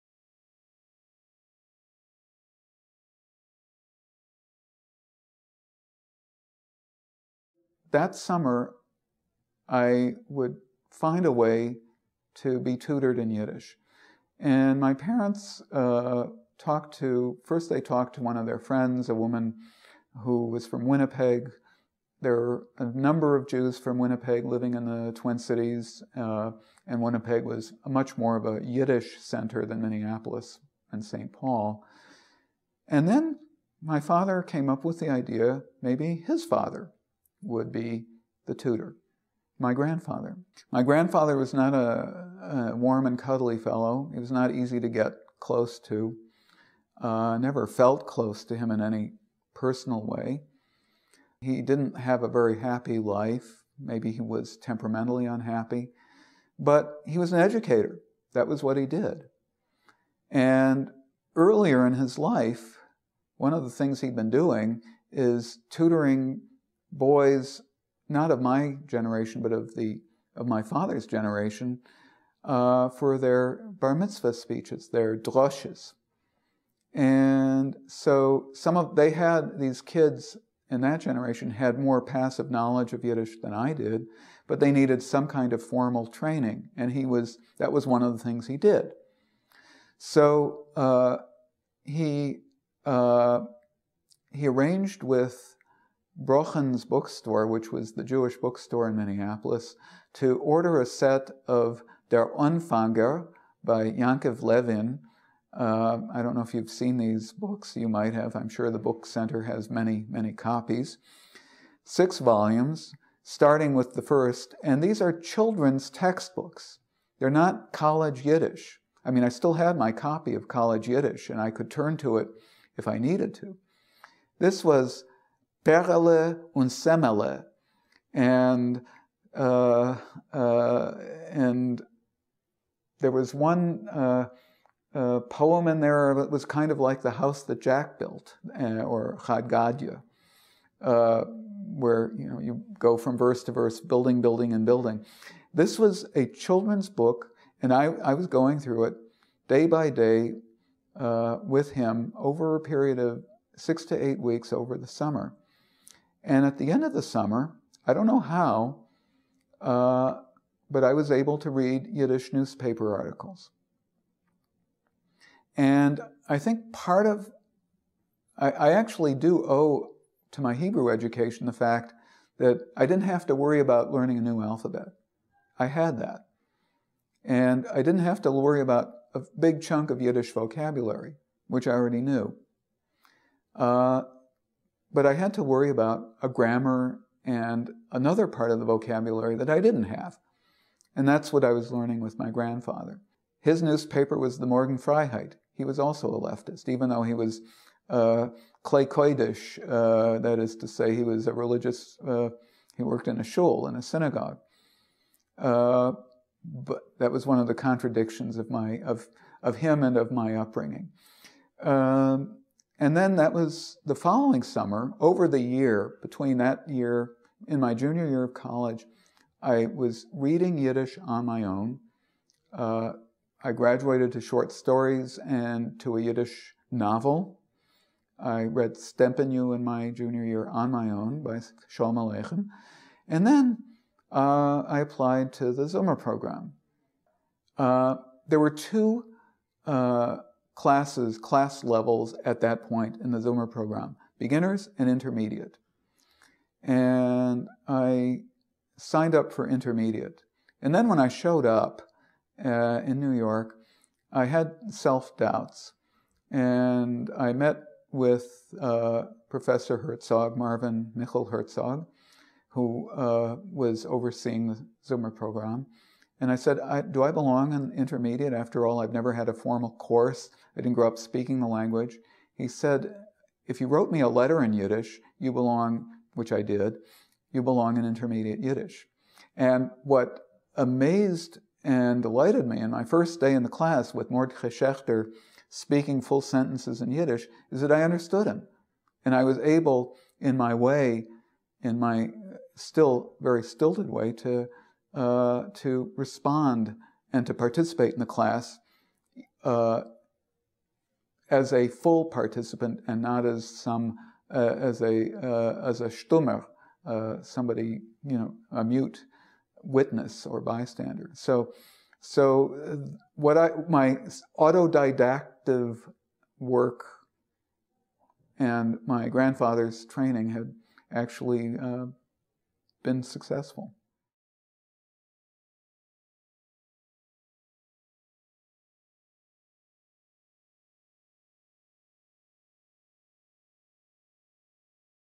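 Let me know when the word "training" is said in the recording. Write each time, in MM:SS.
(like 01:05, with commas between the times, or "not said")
01:26, 05:19.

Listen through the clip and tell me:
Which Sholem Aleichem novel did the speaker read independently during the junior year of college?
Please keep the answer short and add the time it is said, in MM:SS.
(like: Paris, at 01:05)
Stempenu, at 03:48.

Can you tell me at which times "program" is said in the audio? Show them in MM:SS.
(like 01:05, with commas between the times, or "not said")
03:55, 04:03, 04:25.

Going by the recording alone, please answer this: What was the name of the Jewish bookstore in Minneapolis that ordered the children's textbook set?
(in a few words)
Brochen's.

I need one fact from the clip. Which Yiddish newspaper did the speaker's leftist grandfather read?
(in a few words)
Morgen Freiheit.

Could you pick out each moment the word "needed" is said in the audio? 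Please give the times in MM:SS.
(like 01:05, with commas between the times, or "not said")
01:24, 02:02.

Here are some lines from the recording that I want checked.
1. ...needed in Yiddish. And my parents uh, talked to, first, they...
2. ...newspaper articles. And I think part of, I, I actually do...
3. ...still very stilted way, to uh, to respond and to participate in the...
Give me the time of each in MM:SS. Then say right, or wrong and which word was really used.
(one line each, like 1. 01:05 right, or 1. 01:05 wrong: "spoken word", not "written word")
1. 00:12 wrong: "tutored", not "needed"
2. 02:42 right
3. 04:52 right.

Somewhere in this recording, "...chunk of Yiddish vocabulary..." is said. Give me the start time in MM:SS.
02:59.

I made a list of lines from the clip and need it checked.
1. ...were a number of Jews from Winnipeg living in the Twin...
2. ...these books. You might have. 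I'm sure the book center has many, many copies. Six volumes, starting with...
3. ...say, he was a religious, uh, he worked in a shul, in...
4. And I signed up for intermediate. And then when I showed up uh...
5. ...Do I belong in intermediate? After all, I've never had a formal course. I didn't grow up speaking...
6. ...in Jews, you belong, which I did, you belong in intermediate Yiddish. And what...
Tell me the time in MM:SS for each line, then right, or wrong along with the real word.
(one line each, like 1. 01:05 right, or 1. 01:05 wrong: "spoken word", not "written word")
1. 00:22 right
2. 01:46 right
3. 03:20 right
4. 04:06 right
5. 04:26 right
6. 04:34 wrong: "Yiddish", not "Jews".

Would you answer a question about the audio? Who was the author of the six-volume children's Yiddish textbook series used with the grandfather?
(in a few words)
Yankov Levin.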